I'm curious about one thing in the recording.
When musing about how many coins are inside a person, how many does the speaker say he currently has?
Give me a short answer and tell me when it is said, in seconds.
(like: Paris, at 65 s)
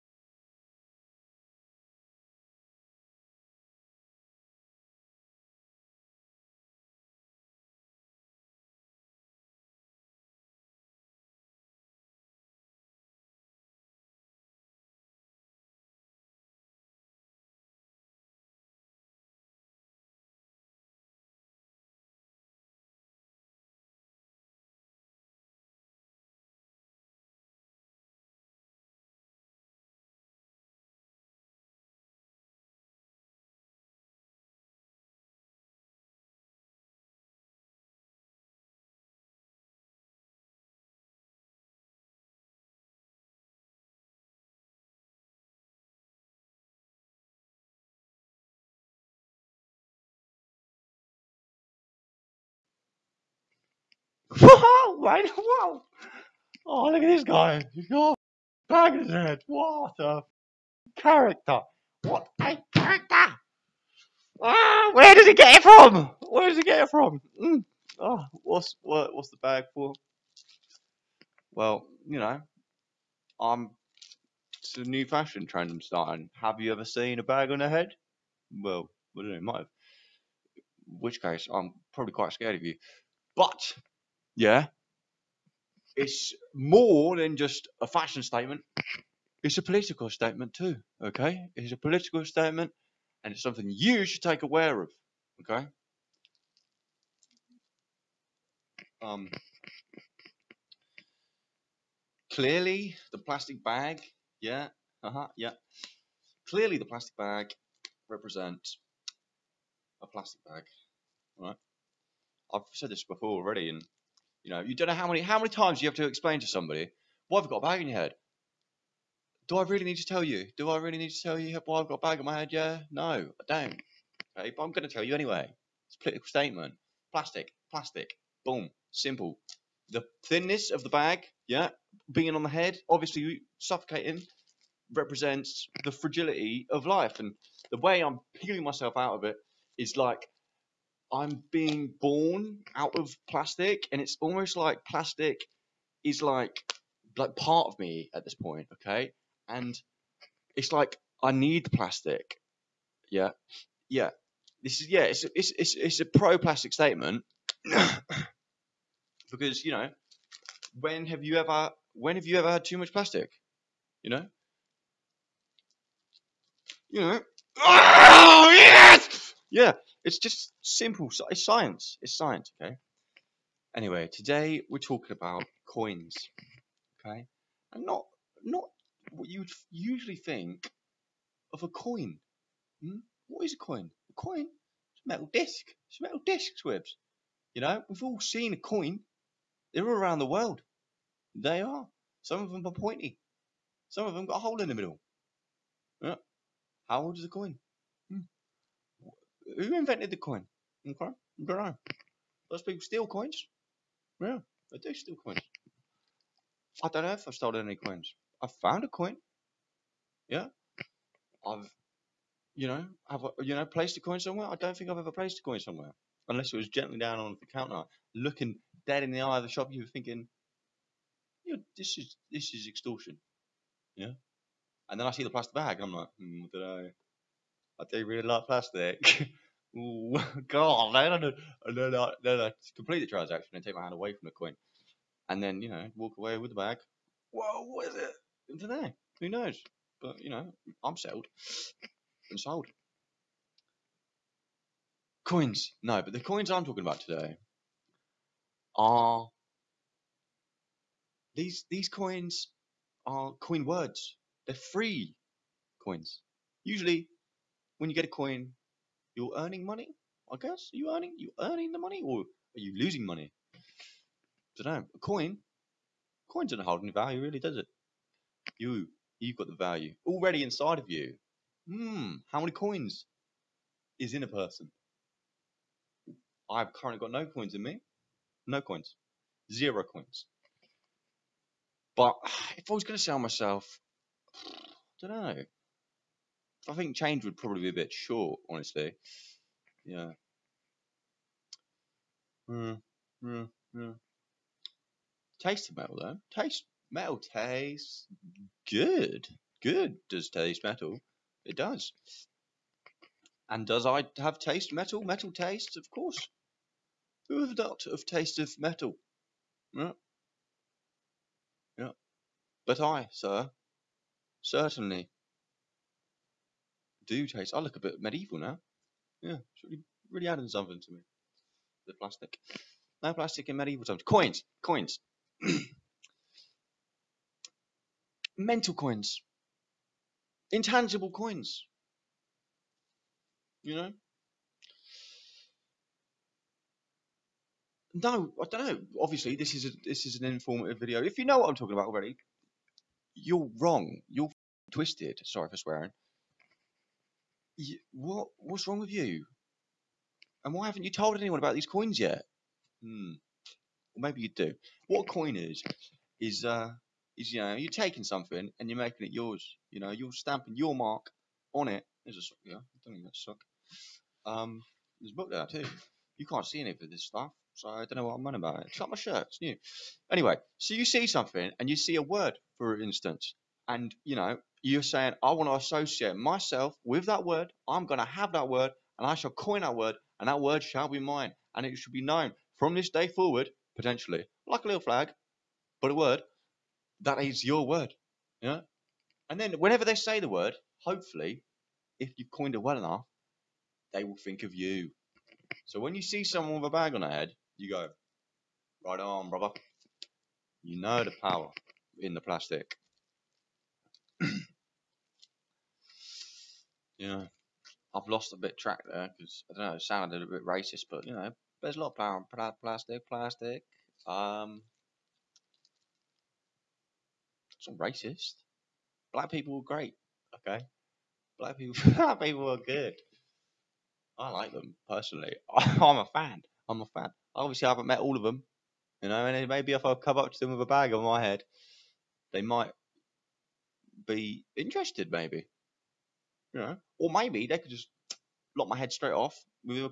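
0, at 279 s.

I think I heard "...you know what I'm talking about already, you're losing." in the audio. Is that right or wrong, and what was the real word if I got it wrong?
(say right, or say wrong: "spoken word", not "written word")
wrong: "wrong", not "losing".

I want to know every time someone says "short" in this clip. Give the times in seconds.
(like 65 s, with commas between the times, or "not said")
287 s.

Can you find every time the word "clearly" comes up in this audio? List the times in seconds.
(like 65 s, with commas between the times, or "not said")
102 s, 106 s.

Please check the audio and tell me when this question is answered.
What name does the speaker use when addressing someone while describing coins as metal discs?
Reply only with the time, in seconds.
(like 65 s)
186 s.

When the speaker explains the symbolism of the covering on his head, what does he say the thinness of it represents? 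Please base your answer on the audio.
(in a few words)
the fragility of life.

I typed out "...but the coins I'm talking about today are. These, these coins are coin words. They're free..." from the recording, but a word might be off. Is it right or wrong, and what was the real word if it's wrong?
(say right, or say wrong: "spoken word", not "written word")
right.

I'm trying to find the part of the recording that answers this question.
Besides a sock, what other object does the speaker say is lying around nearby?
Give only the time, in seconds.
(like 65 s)
365 s.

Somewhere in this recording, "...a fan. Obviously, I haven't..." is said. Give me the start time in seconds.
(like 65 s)
426 s.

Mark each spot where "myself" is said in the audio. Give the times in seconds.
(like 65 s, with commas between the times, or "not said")
138 s, 283 s, 376 s.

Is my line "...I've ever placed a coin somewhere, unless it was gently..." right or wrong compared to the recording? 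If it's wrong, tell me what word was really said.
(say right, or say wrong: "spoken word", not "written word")
right.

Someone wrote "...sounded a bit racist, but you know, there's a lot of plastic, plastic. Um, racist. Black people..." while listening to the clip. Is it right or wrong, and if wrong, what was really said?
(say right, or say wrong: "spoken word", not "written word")
right.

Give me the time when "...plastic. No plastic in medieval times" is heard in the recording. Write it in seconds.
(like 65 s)
321 s.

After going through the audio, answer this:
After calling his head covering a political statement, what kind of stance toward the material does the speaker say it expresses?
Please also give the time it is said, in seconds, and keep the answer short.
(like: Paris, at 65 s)
pro plastic, at 156 s.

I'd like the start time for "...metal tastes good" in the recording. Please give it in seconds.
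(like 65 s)
296 s.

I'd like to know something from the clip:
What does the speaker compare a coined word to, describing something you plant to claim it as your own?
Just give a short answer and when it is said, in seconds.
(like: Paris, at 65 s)
a little flag, at 384 s.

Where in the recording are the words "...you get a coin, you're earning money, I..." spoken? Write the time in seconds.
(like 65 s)
257 s.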